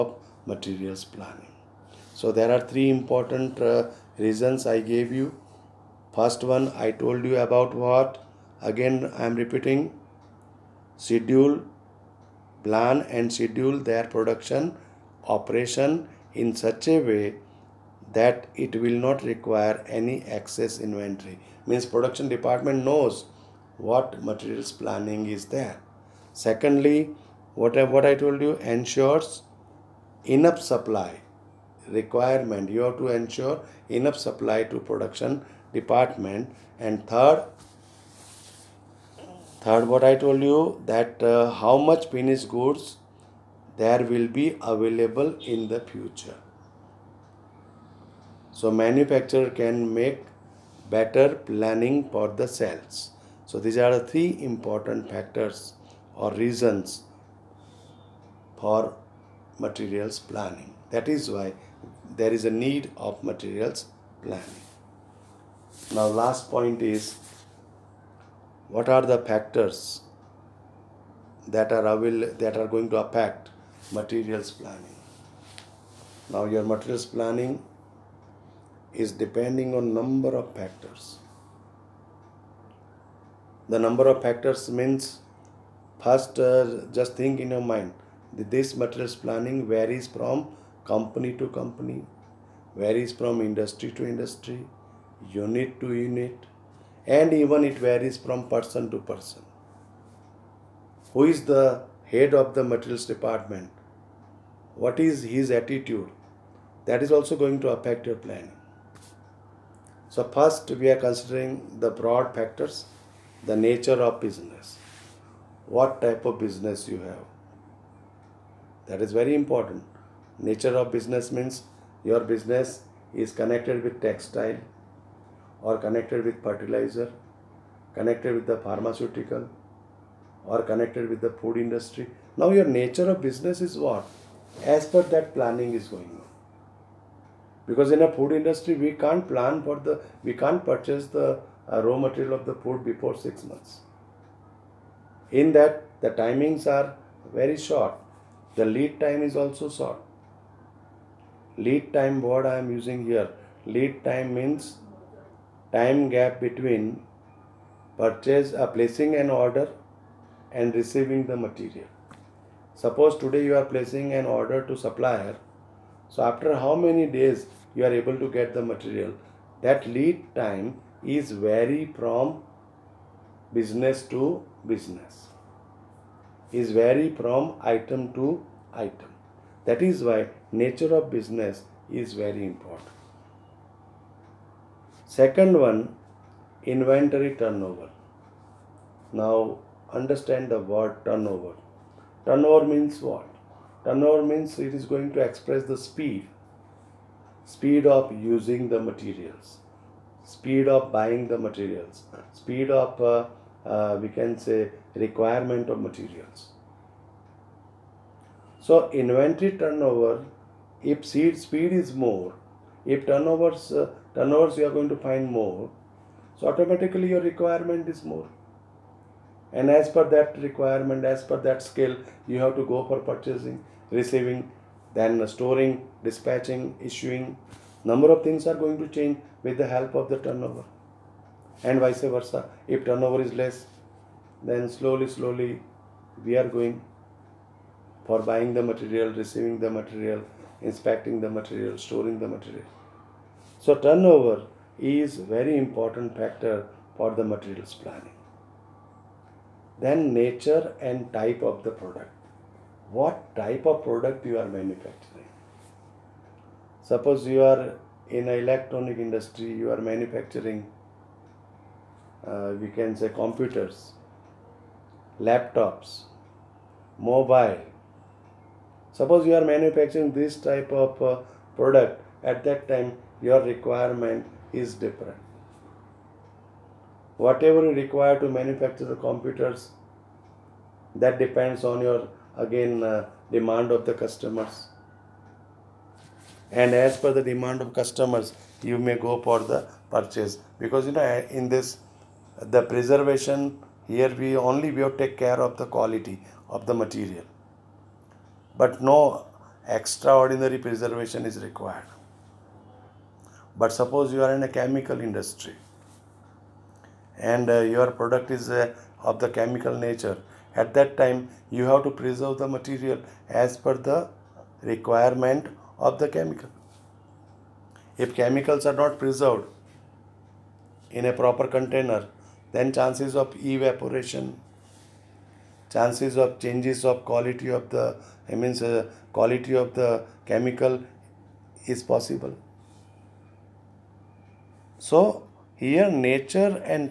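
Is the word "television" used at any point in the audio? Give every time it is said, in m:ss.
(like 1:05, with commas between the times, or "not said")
not said.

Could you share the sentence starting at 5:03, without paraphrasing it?
But suppose you are in a chemical industry and uh, your product is uh, of the chemical nature.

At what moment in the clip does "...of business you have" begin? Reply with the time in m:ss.
1:56.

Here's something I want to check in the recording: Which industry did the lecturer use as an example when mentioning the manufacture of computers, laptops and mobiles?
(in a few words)
Electronic industry.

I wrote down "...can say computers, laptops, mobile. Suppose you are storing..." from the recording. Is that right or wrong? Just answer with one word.
wrong.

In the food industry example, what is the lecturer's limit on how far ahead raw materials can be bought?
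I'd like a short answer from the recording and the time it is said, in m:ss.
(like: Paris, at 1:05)
six months, at 2:23.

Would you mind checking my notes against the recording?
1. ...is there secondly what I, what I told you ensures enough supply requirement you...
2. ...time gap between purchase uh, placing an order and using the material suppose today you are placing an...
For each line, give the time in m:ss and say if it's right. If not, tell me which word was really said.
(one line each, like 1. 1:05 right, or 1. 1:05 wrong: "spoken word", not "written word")
1. 0:25 right
2. 2:35 wrong: "receiving", not "using".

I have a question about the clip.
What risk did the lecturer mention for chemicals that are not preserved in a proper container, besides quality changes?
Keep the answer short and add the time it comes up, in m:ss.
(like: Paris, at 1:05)
Evaporation, at 5:23.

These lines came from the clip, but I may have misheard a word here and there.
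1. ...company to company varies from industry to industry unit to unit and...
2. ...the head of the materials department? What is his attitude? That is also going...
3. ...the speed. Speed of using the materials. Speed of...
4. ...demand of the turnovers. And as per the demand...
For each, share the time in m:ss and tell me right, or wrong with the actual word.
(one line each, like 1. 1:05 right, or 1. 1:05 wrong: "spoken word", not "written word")
1. 1:30 right
2. 1:41 right
3. 3:15 right
4. 4:43 wrong: "customers", not "turnovers".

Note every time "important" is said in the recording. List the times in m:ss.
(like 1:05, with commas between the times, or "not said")
0:02, 0:54, 1:59, 3:02, 4:05.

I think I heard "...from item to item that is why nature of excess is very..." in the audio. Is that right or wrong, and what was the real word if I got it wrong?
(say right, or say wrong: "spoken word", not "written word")
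wrong: "business", not "excess".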